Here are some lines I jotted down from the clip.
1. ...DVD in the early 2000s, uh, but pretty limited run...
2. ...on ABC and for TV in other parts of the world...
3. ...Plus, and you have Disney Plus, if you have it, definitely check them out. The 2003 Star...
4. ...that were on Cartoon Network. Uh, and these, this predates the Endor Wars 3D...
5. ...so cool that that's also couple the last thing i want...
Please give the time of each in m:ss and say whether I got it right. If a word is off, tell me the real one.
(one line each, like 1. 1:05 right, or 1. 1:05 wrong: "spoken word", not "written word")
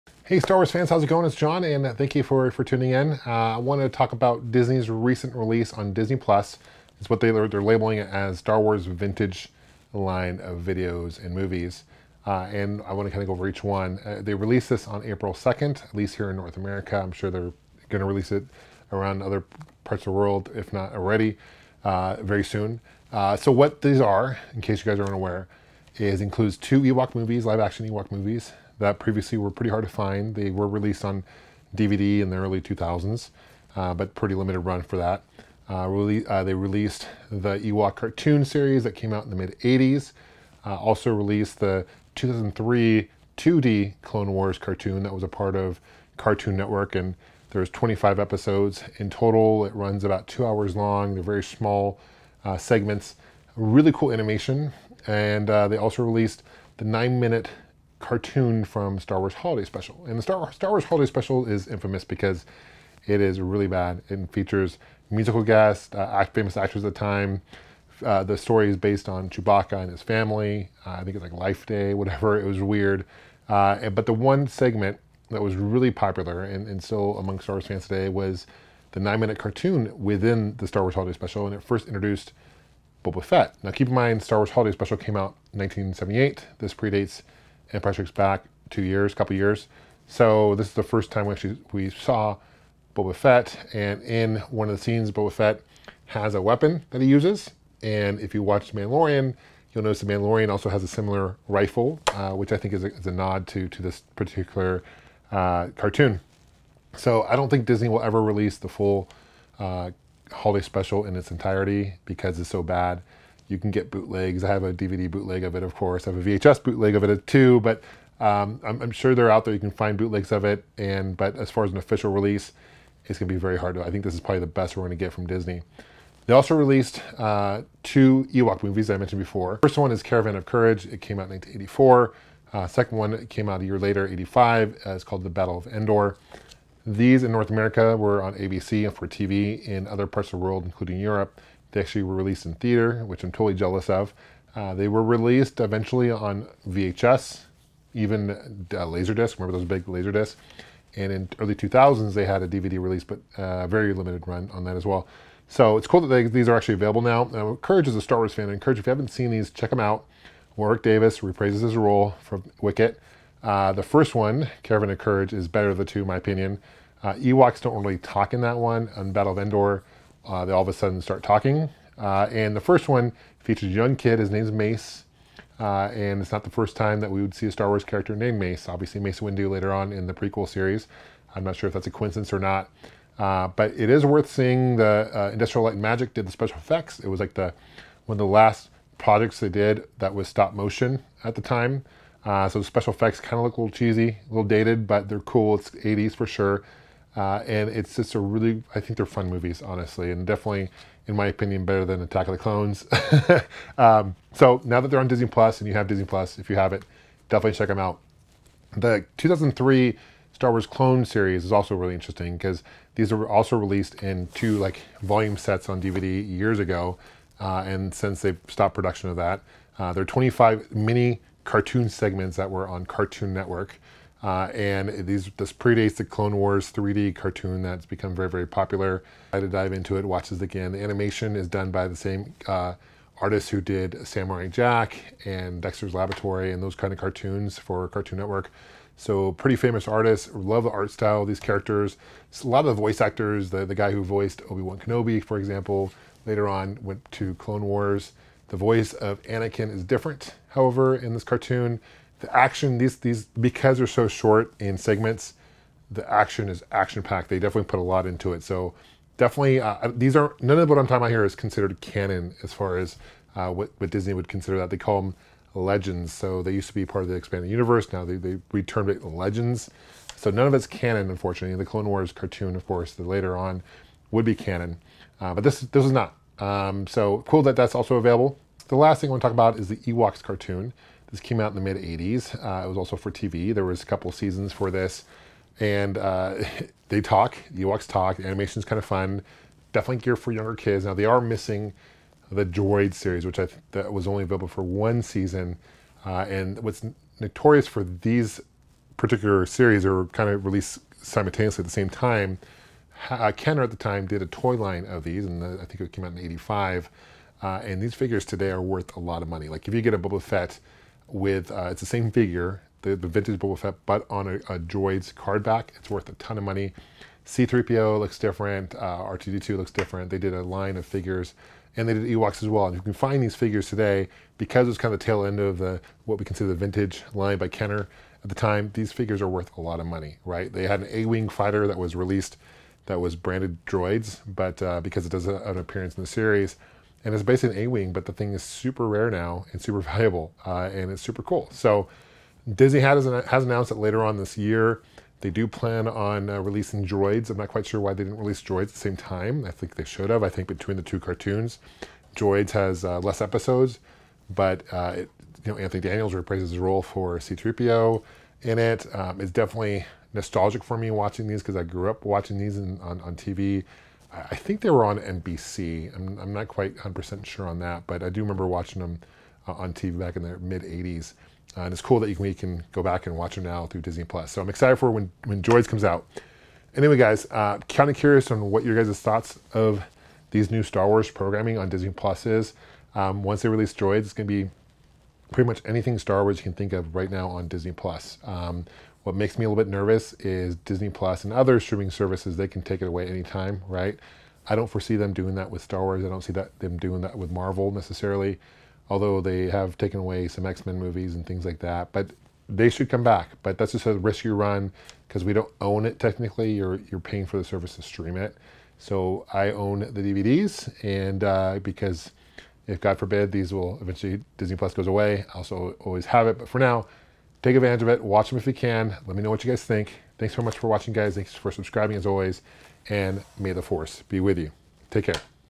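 1. 0:31 right
2. 2:18 right
3. 3:25 right
4. 3:42 wrong: "Clone", not "Endor"
5. 4:36 wrong: "available", not "couple".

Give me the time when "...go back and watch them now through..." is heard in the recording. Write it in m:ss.
6:12.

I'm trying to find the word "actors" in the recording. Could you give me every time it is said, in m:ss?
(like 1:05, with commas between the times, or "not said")
1:06, 4:03.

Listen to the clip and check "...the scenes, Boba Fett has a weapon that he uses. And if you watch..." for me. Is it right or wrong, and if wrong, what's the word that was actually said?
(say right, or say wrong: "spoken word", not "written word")
right.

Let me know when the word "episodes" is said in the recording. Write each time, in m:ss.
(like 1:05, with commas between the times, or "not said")
0:48, 5:53.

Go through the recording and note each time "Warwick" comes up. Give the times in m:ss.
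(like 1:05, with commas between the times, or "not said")
2:40.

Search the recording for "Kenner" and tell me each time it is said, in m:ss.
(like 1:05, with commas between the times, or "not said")
5:03, 5:27.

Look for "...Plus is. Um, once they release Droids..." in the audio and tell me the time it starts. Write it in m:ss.
6:21.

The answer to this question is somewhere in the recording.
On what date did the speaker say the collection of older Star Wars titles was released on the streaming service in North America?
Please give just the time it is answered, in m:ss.
0:15.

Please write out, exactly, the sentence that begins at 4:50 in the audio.
Now, they are missing the Droid series, which I th- that was only available for one season.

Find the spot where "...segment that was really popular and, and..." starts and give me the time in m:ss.
1:14.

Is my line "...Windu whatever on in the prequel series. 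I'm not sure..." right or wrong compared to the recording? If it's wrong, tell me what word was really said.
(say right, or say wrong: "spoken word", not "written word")
wrong: "later", not "whatever".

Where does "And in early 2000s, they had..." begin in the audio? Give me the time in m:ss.
2:30.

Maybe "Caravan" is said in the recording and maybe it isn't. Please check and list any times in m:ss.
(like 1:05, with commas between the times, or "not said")
2:10, 2:44.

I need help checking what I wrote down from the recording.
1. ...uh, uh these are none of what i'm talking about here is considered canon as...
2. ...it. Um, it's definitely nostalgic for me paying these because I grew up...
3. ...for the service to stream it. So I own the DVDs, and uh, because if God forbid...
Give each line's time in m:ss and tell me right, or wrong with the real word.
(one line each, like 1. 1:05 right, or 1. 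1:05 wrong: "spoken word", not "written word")
1. 4:19 right
2. 5:58 wrong: "watching", not "paying"
3. 6:47 right.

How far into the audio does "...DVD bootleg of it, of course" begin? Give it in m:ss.
1:54.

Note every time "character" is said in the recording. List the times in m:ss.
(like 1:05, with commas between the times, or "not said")
2:57, 4:01.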